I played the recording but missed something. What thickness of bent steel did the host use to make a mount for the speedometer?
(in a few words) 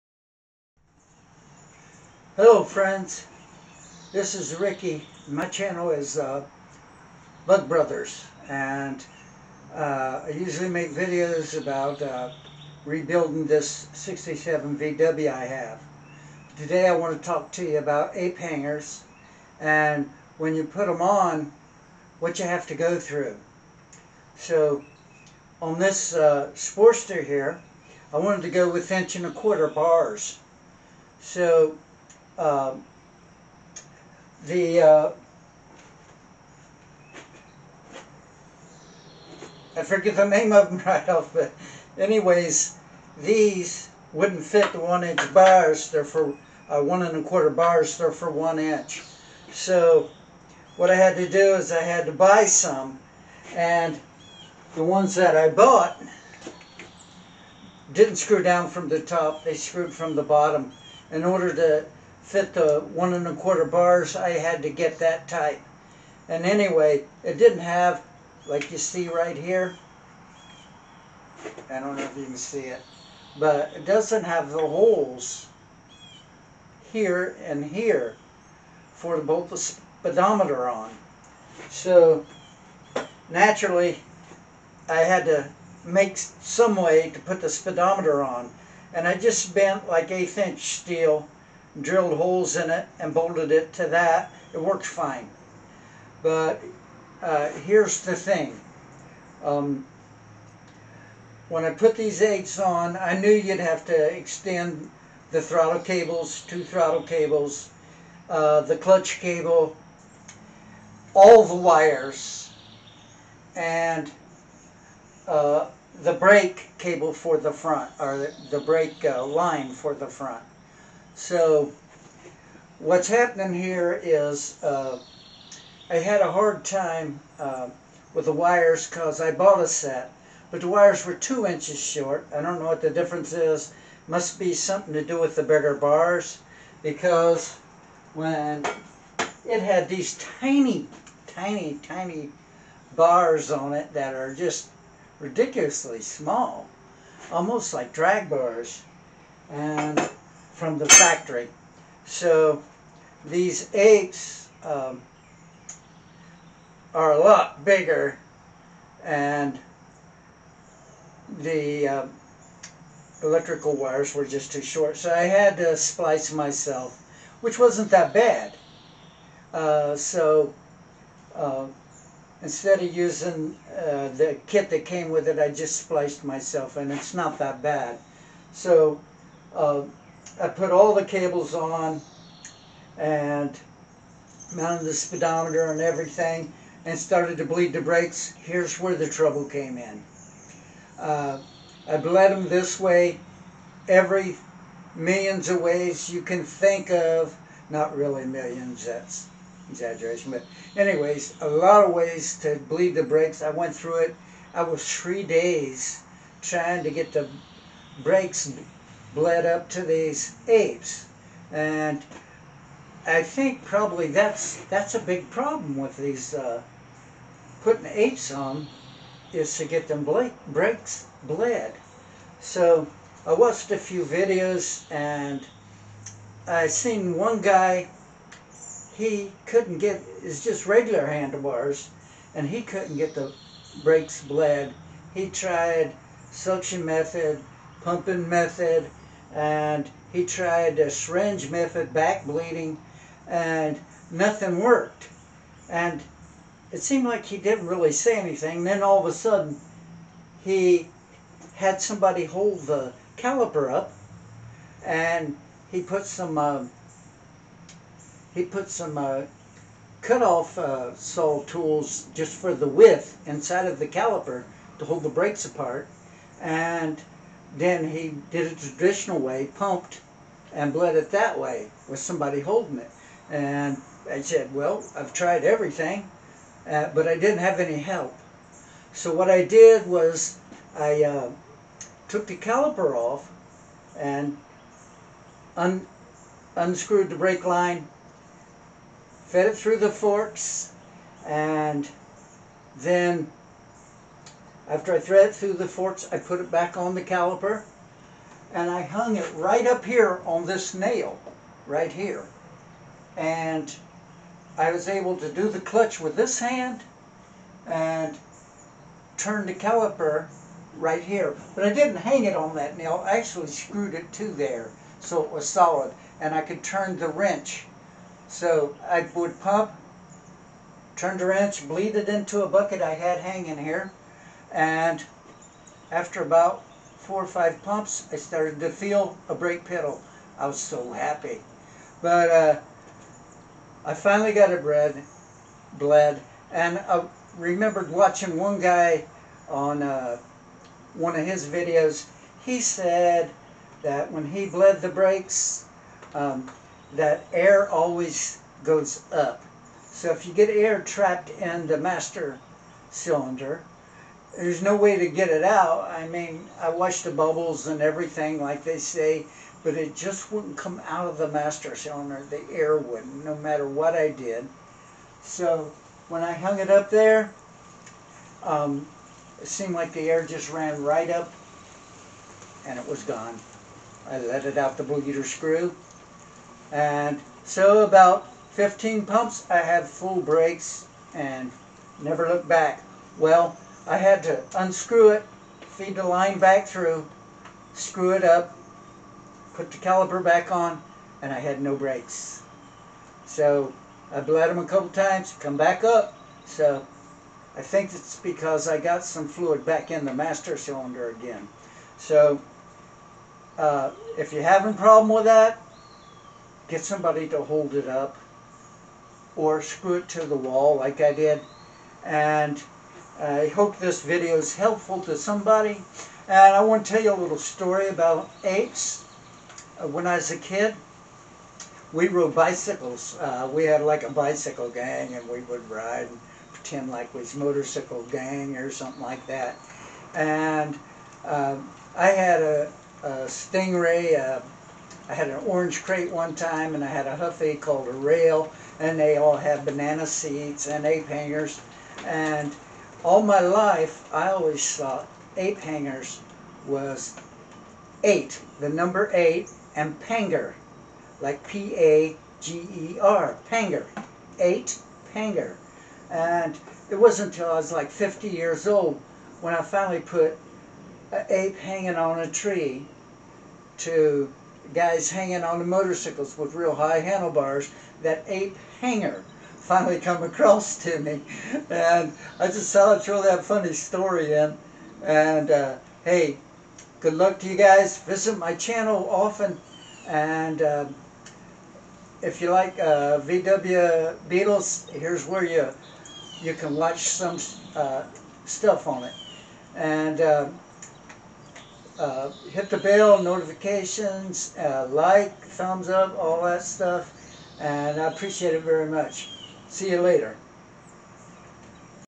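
eighth inch.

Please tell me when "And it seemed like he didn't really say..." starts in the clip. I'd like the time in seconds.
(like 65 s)
245 s.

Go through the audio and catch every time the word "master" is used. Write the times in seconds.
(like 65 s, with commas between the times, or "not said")
351 s, 361 s, 400 s.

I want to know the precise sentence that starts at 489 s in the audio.
And um, uh, hit the bell, notifications, uh, like, thumbs up, all that stuff.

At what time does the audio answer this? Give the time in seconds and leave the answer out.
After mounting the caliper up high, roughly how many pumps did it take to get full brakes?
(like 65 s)
378 s.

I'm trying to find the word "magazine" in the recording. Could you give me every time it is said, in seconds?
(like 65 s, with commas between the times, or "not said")
not said.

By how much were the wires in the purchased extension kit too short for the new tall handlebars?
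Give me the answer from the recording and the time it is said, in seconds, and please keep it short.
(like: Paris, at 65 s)
2 inches, at 131 s.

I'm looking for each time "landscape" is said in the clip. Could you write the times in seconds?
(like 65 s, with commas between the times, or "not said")
not said.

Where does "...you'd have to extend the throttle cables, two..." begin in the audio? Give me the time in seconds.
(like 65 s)
103 s.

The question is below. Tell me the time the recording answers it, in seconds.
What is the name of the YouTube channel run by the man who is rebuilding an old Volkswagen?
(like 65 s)
7 s.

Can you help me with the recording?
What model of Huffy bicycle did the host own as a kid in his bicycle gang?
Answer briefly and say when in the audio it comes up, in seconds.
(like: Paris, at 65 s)
rail, at 437 s.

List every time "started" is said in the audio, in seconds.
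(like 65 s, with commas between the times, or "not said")
186 s, 328 s.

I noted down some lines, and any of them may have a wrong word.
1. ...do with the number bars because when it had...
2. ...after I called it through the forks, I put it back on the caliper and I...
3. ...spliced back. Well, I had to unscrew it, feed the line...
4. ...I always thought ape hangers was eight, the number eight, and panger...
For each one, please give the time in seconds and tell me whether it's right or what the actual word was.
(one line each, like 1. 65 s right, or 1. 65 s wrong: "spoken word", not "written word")
1. 135 s wrong: "bigger", not "number"
2. 294 s wrong: "threaded", not "called"
3. 382 s wrong: "looked", not "spliced"
4. 444 s right.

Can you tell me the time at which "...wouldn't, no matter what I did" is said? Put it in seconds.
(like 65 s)
362 s.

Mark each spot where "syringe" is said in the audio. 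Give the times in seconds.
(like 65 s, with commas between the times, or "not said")
240 s.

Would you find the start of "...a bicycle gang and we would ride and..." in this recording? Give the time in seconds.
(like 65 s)
424 s.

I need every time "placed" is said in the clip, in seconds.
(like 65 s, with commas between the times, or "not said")
not said.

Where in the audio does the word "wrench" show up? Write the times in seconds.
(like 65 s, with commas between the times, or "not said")
317 s, 321 s.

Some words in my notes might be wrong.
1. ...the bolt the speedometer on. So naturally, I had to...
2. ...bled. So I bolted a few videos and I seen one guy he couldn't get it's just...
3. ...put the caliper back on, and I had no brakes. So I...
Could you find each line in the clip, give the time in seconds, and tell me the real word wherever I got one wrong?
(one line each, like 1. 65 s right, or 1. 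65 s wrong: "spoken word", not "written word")
1. 79 s right
2. 221 s wrong: "watched", not "bolted"
3. 389 s right.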